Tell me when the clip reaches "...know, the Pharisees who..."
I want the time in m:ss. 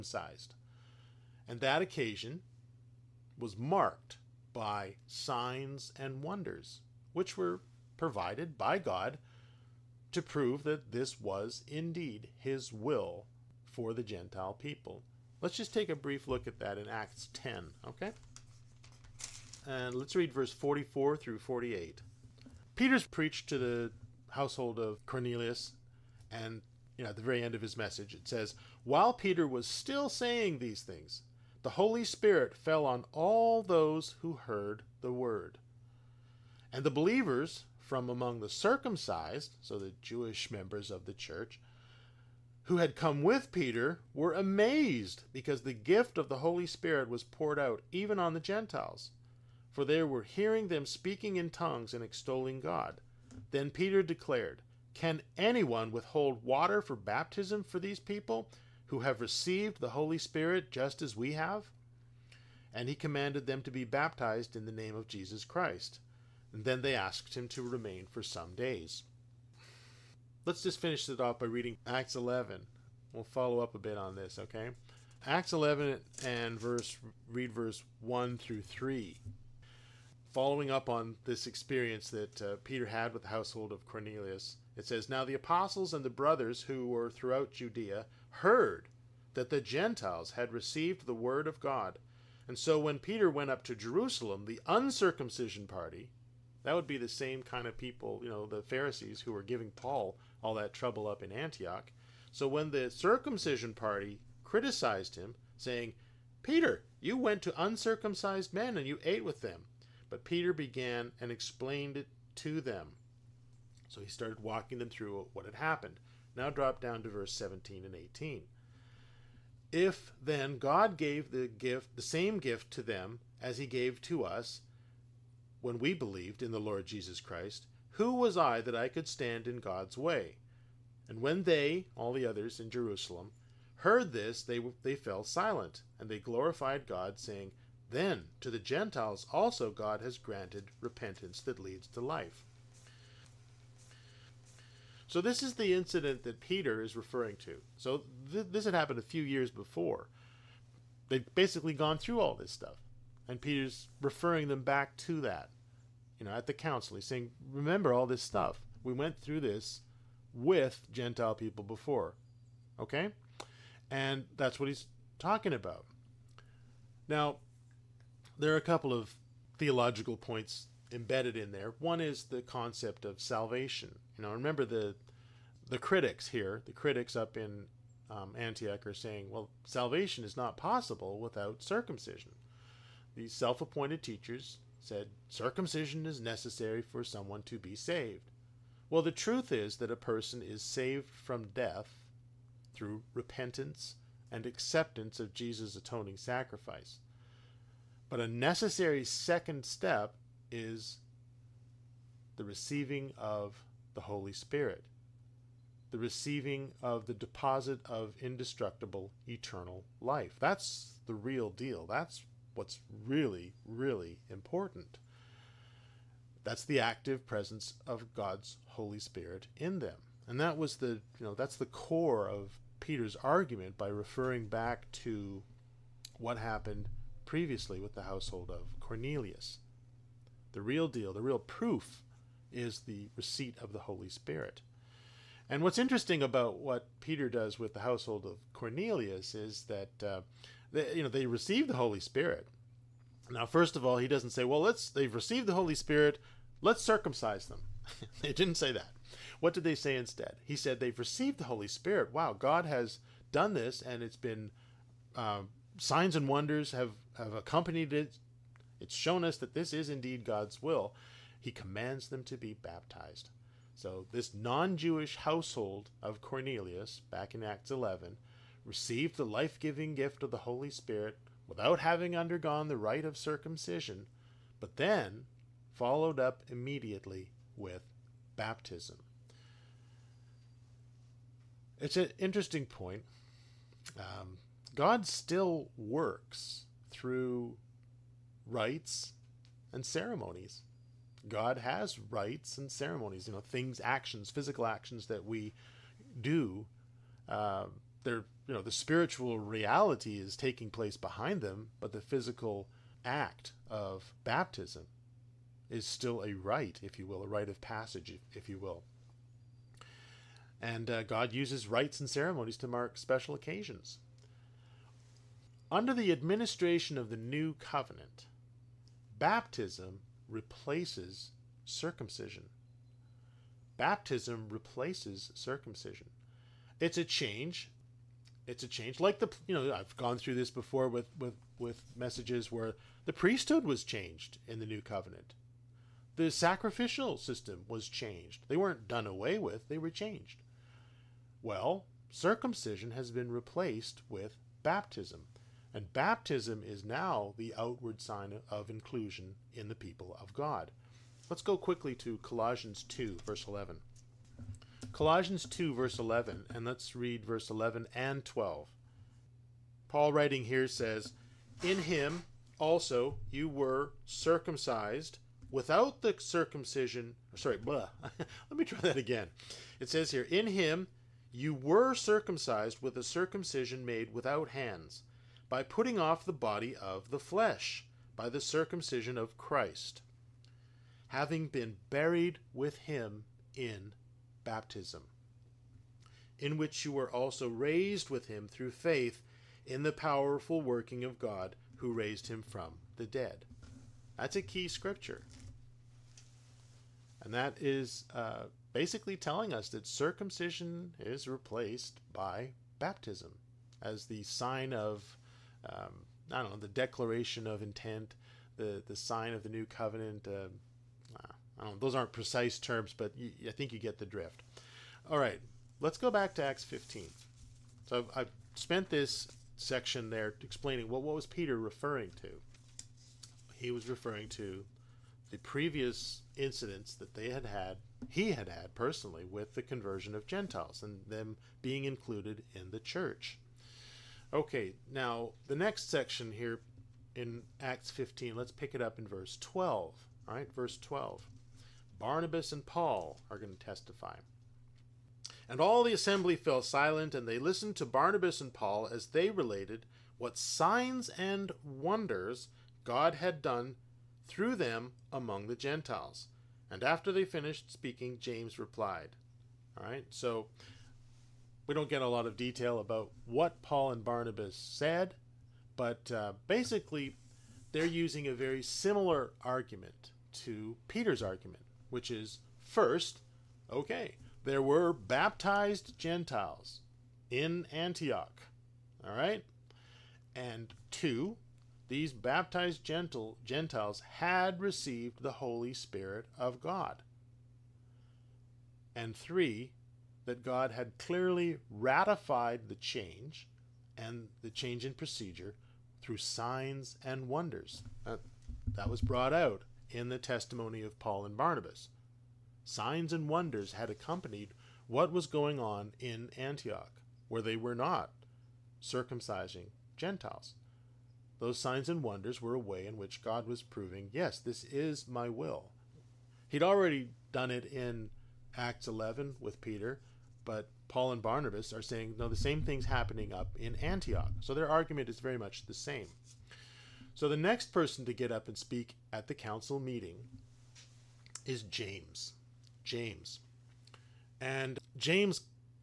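1:38.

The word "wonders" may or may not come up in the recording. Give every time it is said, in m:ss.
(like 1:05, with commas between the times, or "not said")
0:06, 4:16, 7:31, 8:17, 8:23, 8:32.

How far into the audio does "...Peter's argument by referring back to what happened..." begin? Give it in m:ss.
3:42.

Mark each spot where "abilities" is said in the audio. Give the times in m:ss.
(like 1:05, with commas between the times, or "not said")
not said.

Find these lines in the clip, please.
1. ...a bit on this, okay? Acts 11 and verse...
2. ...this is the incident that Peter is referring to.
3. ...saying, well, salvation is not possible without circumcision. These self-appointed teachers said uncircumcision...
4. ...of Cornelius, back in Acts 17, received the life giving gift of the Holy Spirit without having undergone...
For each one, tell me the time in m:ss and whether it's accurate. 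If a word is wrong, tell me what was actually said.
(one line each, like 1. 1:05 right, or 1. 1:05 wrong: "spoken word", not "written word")
1. 1:13 right
2. 2:25 right
3. 2:58 wrong: "circumcision", not "uncircumcision"
4. 4:26 wrong: "11", not "17".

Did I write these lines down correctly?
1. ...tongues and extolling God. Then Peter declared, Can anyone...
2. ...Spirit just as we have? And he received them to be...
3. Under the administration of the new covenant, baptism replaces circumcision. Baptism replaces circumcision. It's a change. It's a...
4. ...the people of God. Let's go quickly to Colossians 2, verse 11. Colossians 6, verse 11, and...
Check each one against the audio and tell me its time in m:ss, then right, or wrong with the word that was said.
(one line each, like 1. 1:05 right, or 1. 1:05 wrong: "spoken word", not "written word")
1. 0:51 right
2. 1:00 wrong: "commanded", not "received"
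3. 5:15 right
4. 5:49 wrong: "2", not "6".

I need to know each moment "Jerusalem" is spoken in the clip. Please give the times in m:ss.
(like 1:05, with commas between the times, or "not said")
1:33, 2:12.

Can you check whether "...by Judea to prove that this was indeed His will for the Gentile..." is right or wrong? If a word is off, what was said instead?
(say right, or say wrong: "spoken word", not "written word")
wrong: "God", not "Judea".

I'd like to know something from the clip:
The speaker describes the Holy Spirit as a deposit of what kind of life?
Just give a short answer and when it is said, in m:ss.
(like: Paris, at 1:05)
indestructible eternal life, at 3:28.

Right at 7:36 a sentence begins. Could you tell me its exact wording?
And after they finished speaking, James replied.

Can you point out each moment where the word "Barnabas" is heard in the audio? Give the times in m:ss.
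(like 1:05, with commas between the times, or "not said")
7:22, 7:27, 7:44, 8:21, 8:41.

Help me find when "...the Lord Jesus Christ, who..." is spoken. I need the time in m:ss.
2:06.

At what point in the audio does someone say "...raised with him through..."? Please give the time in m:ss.
6:27.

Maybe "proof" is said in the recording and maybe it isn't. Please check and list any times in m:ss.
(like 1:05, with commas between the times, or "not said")
3:51.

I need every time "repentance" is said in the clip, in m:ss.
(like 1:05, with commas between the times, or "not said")
2:20, 3:13.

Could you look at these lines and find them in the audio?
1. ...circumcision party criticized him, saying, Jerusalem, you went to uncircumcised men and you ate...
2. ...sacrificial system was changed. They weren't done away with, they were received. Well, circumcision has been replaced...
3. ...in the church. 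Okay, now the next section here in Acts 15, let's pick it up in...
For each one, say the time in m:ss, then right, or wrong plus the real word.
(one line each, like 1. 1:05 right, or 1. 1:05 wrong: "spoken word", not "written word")
1. 1:42 wrong: "Peter", not "Jerusalem"
2. 5:36 wrong: "changed", not "received"
3. 7:12 right.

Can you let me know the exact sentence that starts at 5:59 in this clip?
Paul, writing here, says, In him also you were circumcised without the circumcision.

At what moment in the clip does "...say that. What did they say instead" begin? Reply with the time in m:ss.
4:08.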